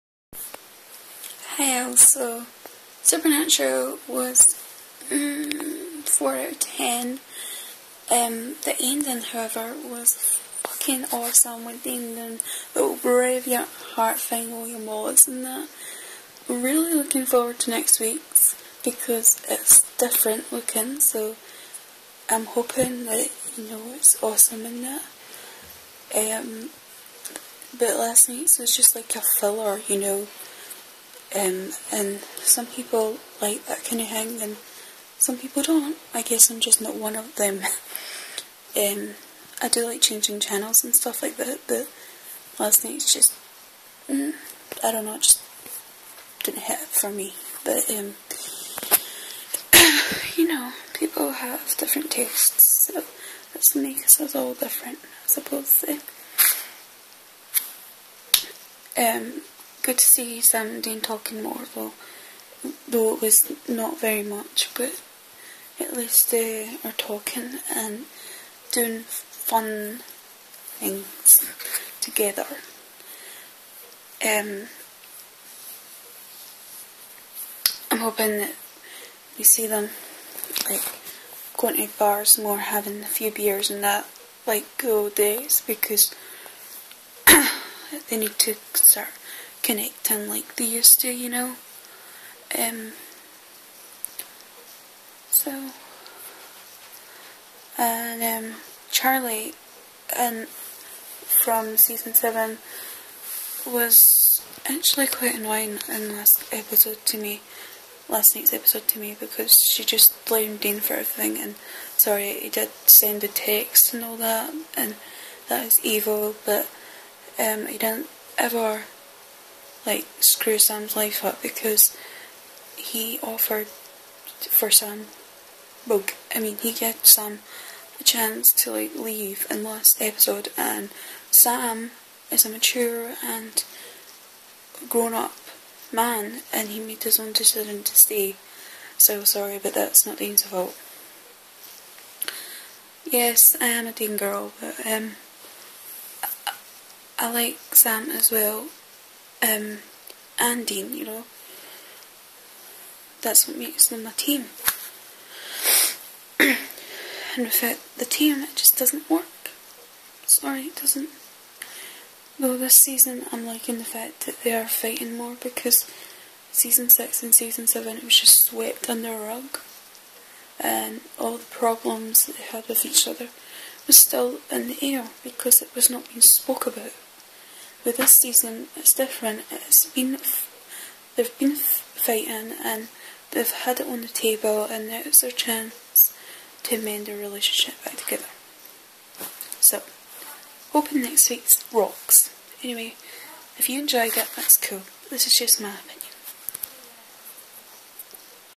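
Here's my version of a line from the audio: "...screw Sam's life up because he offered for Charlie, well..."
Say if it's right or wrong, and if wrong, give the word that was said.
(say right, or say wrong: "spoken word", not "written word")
wrong: "Sam", not "Charlie".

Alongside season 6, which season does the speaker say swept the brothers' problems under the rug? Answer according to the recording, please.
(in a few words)
Season 7.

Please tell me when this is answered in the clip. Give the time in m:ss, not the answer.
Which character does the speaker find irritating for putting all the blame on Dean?
1:38.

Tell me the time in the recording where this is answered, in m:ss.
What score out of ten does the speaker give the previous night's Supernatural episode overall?
0:06.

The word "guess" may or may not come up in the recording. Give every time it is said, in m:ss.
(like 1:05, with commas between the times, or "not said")
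0:36.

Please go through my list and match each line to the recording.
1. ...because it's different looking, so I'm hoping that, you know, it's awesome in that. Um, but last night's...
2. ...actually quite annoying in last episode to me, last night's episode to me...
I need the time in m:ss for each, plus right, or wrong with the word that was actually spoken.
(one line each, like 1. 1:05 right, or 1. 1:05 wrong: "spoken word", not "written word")
1. 0:18 right
2. 1:44 right.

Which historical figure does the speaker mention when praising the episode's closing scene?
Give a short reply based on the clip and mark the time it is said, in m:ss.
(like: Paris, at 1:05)
William Wallace, at 0:14.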